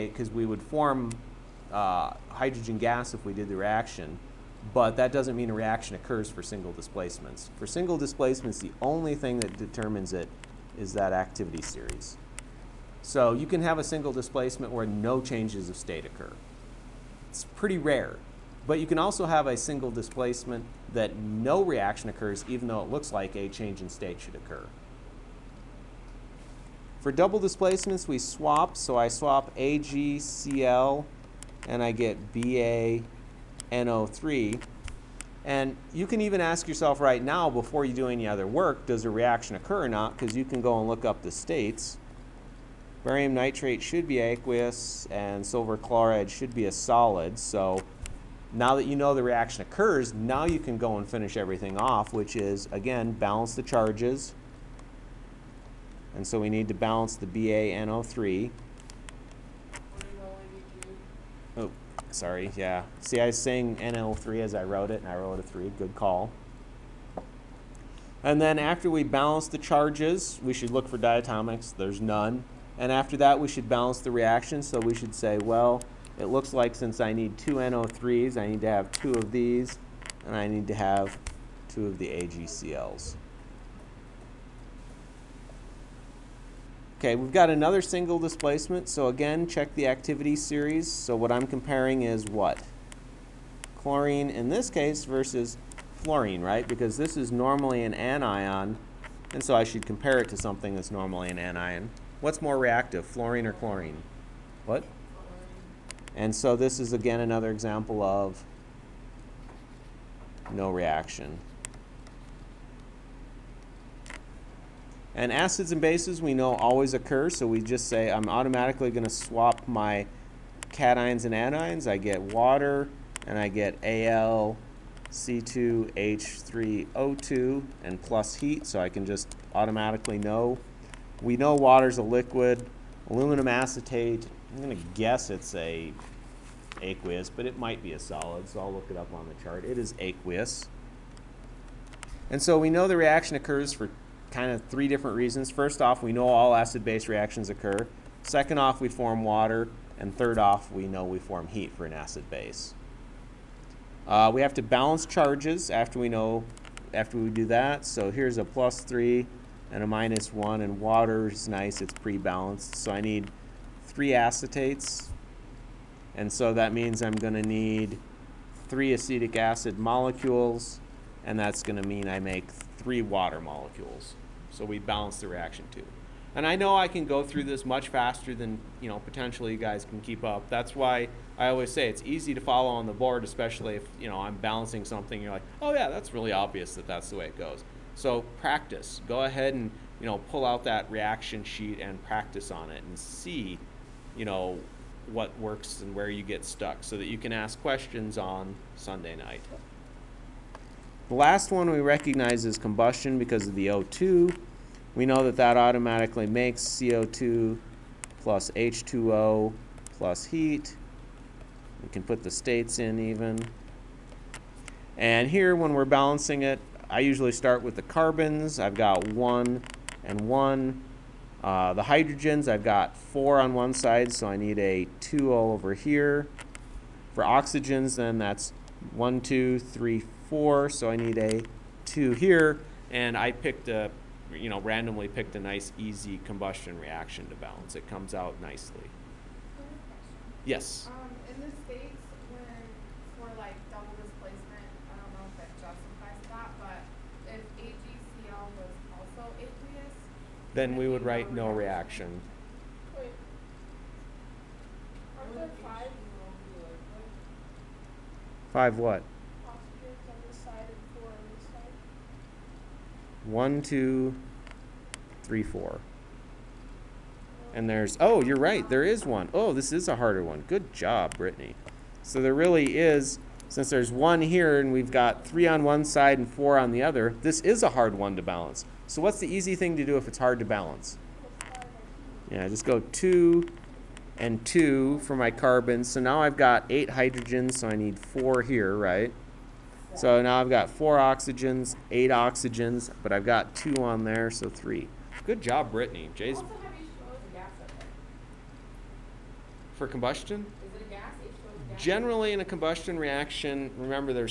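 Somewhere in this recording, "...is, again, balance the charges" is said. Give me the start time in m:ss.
0:52.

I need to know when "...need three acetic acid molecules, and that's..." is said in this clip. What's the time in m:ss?
2:47.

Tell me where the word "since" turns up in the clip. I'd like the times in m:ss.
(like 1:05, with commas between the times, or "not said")
1:16, 4:33.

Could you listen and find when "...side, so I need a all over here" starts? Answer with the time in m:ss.
3:43.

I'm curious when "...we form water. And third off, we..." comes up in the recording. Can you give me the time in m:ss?
2:28.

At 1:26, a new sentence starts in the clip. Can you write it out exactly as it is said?
Okay, we've got another single displacement.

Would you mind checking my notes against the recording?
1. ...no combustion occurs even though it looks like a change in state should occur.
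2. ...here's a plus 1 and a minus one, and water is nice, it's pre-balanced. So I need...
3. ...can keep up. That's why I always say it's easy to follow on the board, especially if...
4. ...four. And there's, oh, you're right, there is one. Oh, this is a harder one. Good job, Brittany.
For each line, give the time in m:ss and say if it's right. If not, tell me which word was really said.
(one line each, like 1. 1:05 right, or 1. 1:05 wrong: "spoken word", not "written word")
1. 0:21 wrong: "reaction", not "combustion"
2. 2:38 wrong: "3", not "1"
3. 2:59 right
4. 4:25 right.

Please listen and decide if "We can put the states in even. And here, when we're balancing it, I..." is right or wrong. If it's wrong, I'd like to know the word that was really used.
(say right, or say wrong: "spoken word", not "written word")
right.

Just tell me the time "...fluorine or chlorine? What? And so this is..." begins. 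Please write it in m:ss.
1:43.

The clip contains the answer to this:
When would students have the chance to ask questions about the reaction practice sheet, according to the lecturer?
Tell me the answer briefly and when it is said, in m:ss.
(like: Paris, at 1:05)
Sunday night, at 3:18.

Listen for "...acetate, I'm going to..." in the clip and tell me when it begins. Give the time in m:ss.
2:13.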